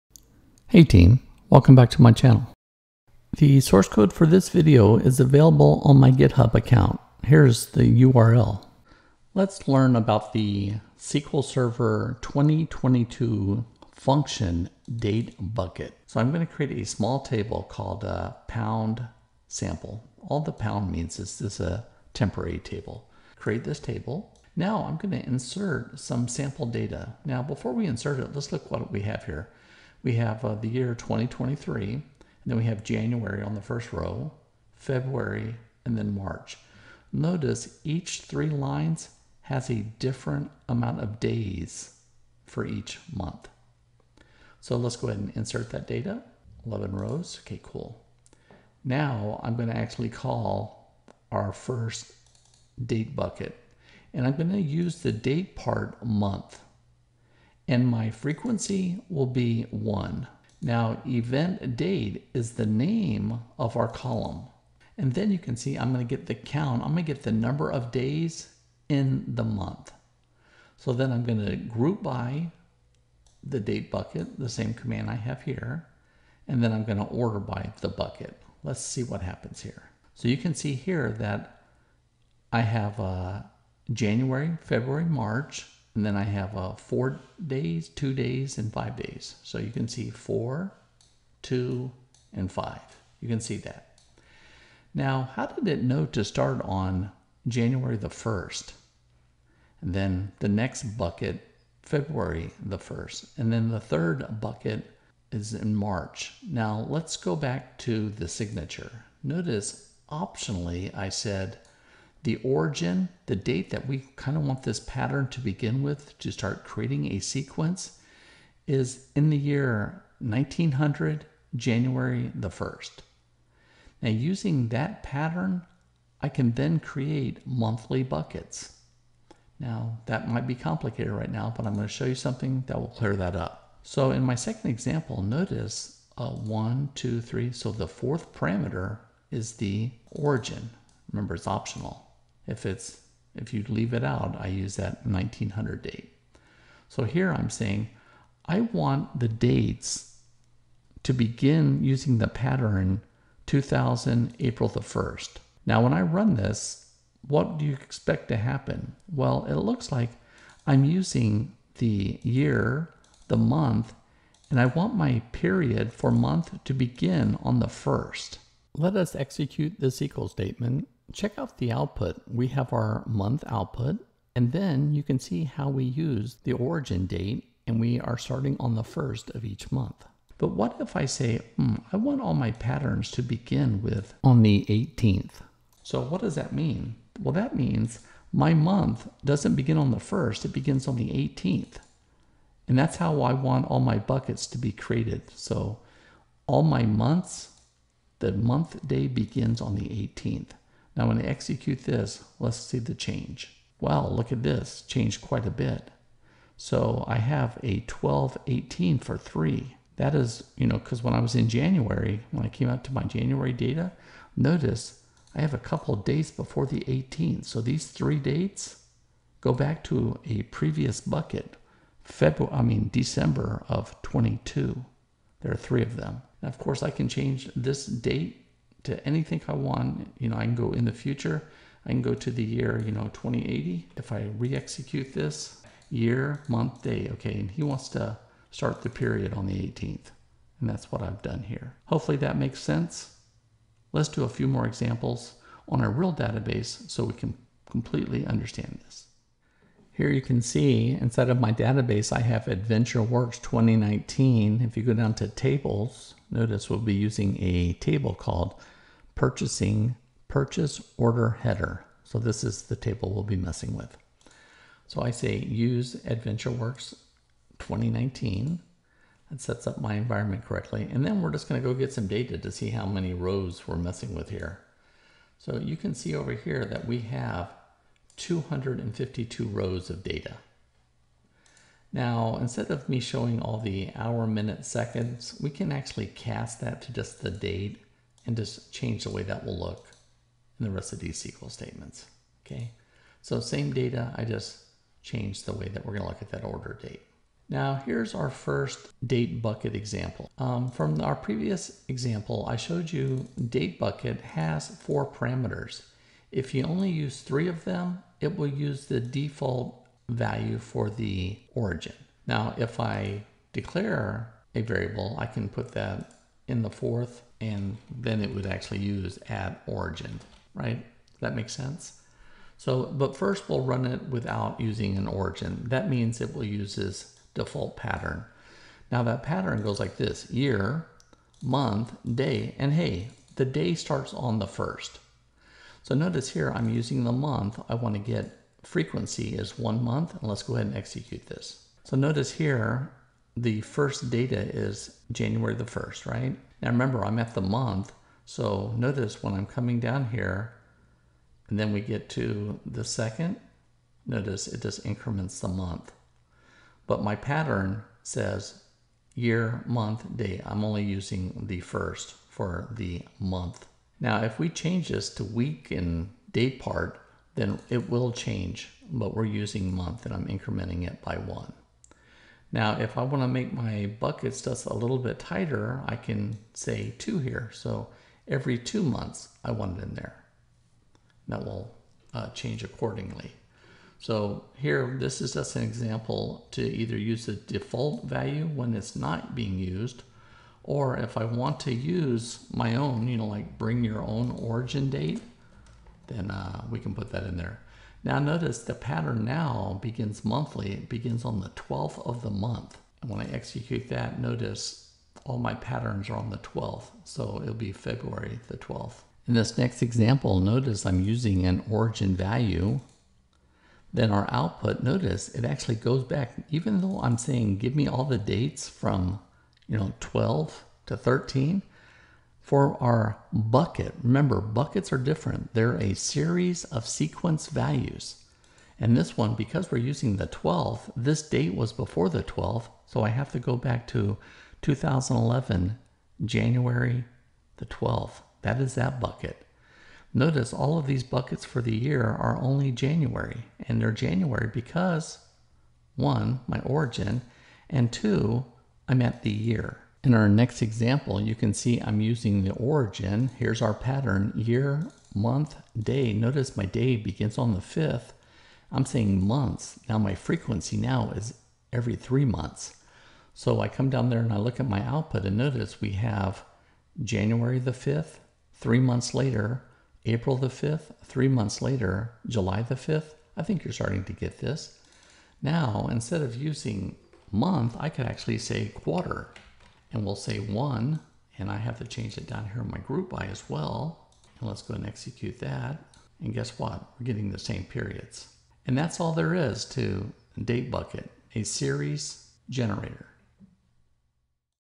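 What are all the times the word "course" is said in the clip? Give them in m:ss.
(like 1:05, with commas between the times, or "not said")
3:46.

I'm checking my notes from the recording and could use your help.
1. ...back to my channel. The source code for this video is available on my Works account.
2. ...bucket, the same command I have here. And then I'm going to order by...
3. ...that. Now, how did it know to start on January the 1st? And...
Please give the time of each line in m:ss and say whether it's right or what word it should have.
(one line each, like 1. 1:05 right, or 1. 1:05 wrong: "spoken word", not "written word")
1. 0:01 wrong: "GitHub", not "Works"
2. 1:13 right
3. 1:33 right.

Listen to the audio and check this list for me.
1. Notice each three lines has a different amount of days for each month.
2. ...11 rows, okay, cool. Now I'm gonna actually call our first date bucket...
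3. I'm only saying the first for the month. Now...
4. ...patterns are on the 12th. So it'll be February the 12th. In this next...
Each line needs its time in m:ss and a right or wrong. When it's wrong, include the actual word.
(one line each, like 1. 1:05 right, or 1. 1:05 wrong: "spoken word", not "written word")
1. 0:37 right
2. 0:46 right
3. 6:00 wrong: "using", not "saying"
4. 6:45 right.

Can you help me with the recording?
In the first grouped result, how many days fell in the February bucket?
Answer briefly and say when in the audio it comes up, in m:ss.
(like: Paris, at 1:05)
2, at 1:27.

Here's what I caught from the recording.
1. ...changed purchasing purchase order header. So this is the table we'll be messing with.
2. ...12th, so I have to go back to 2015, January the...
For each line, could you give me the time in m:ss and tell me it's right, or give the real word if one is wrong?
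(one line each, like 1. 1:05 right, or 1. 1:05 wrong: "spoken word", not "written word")
1. 4:18 wrong: "called", not "changed"
2. 7:12 wrong: "2011", not "2015".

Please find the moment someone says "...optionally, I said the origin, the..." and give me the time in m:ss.
1:50.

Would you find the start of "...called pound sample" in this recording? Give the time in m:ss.
0:17.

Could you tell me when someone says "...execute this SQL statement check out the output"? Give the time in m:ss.
2:49.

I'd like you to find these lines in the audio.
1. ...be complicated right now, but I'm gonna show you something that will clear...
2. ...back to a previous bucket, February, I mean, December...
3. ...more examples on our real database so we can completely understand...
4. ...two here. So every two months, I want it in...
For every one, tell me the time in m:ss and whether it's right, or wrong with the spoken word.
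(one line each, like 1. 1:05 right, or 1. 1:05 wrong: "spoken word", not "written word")
1. 2:10 right
2. 3:39 right
3. 4:04 right
4. 6:16 right.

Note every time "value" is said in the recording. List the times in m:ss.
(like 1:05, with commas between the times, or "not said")
5:10, 6:28, 6:52, 7:07.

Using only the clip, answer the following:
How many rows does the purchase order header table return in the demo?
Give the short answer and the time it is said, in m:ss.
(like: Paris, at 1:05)
252, at 4:38.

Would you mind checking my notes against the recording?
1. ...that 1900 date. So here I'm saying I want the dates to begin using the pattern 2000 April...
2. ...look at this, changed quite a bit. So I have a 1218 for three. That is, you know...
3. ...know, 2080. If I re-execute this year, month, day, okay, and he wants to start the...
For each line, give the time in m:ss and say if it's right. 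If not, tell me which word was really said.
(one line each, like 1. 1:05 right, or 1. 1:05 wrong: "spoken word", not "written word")
1. 2:24 right
2. 3:24 right
3. 3:52 right.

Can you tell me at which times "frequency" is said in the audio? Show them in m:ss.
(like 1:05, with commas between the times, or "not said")
0:58, 5:38, 7:40.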